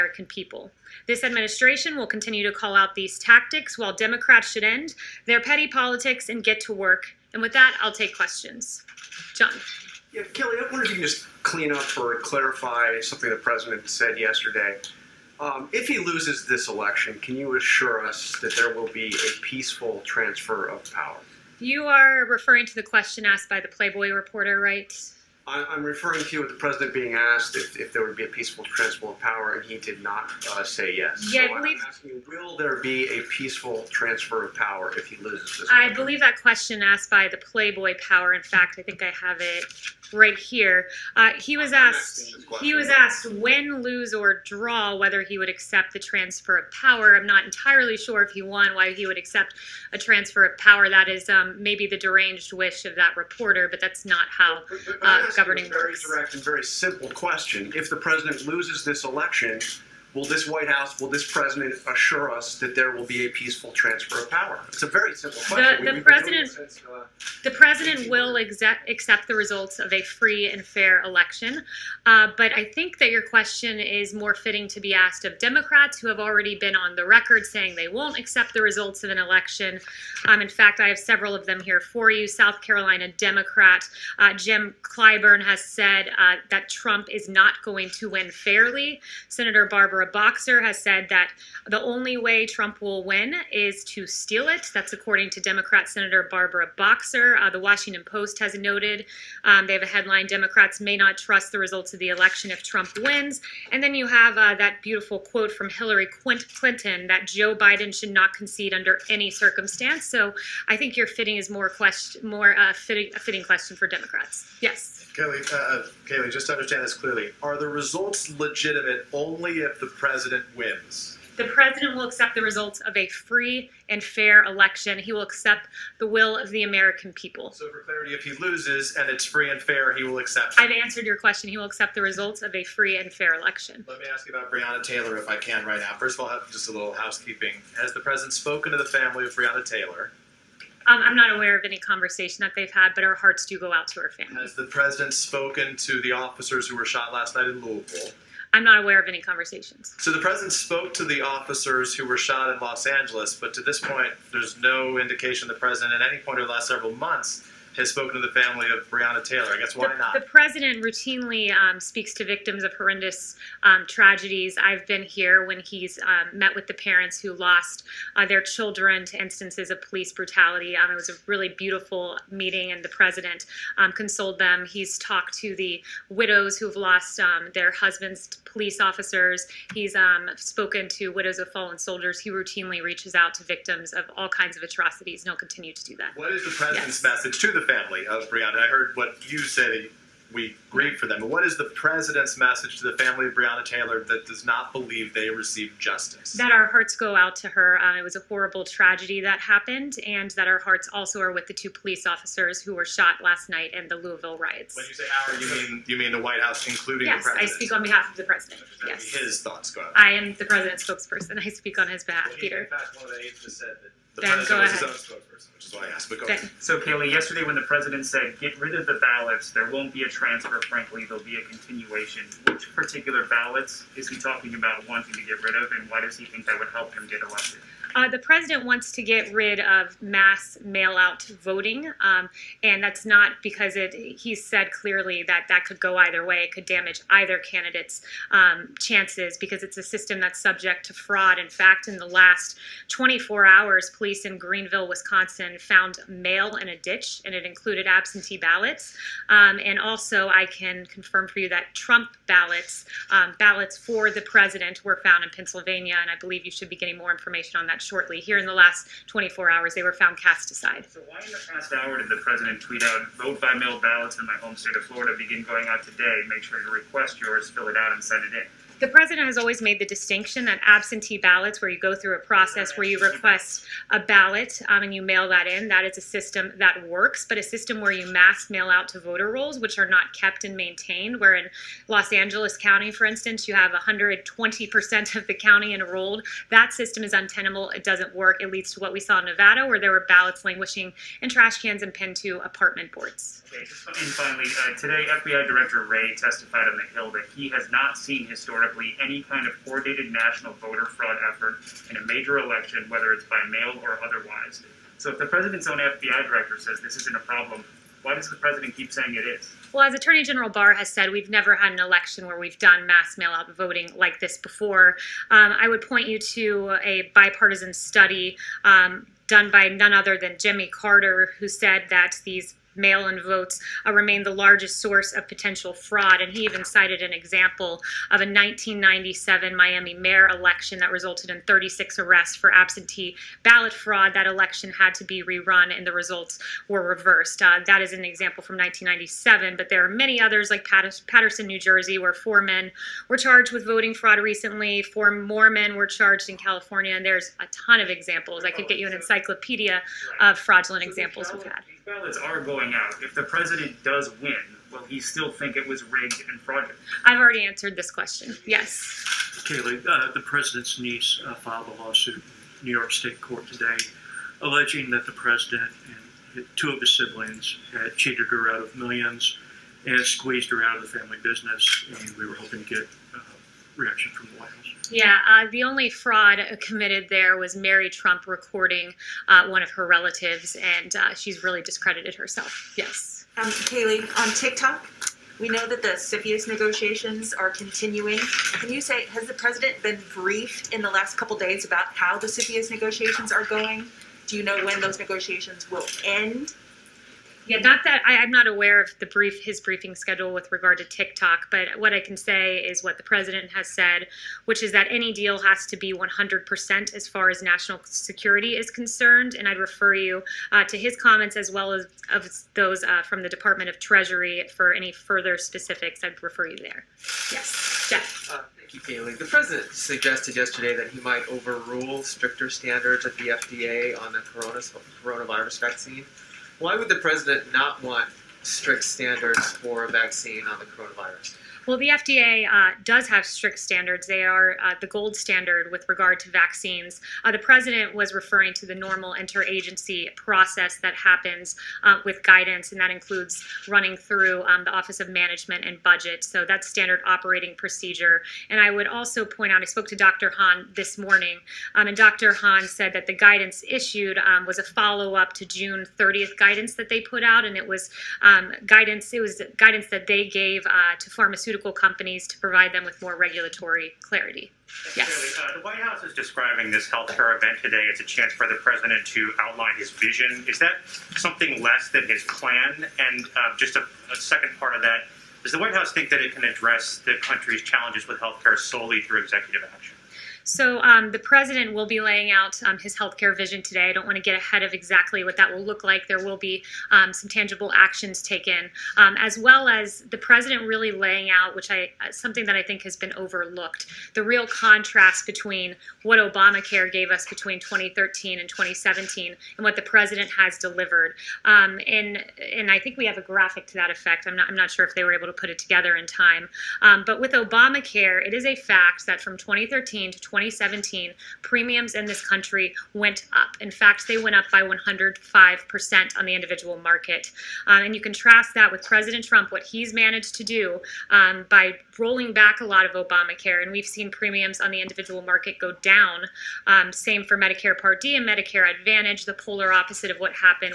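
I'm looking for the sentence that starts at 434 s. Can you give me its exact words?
They are uh, the gold standard with regard to vaccines.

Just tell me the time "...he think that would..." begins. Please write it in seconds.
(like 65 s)
226 s.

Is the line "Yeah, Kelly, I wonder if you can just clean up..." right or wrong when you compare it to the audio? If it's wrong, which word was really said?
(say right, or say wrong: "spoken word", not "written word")
right.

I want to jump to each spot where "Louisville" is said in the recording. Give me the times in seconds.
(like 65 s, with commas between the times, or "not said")
147 s, 203 s.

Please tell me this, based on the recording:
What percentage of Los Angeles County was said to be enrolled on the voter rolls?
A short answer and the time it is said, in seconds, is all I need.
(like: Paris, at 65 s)
120%, at 283 s.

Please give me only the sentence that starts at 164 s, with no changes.
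I've been here when he's um, met with the parents who lost uh, their children to instances of police brutality.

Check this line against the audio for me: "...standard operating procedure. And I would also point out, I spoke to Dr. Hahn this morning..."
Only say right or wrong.
right.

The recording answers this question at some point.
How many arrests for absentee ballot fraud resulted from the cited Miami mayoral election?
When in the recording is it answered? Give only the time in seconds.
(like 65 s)
331 s.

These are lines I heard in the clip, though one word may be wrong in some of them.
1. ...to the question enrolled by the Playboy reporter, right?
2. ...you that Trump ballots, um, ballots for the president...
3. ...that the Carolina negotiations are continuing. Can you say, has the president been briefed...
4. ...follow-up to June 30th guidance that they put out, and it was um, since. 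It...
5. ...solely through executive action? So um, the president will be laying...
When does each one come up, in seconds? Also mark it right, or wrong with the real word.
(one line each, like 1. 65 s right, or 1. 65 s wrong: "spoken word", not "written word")
1. 22 s wrong: "asked", not "enrolled"
2. 251 s right
3. 385 s wrong: "CFIUS", not "Carolina"
4. 454 s wrong: "guidance", not "since"
5. 478 s right.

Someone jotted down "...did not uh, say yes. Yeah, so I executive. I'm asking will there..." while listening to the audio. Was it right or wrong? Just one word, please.
wrong.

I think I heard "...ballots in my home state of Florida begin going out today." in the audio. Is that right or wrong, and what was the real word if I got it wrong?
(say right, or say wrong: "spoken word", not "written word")
right.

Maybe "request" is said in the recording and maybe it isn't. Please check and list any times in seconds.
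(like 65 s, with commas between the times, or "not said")
266 s, 272 s.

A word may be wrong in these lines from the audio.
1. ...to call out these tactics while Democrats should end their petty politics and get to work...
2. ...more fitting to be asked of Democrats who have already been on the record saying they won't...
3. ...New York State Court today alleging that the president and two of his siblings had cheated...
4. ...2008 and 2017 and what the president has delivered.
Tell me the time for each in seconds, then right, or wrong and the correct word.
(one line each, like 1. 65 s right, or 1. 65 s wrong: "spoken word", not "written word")
1. 2 s right
2. 74 s right
3. 362 s right
4. 497 s wrong: "2013", not "2008".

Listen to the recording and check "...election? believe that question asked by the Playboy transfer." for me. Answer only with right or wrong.
wrong.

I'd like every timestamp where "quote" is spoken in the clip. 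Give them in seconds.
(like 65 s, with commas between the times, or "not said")
105 s.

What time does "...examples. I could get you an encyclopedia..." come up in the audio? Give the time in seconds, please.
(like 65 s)
347 s.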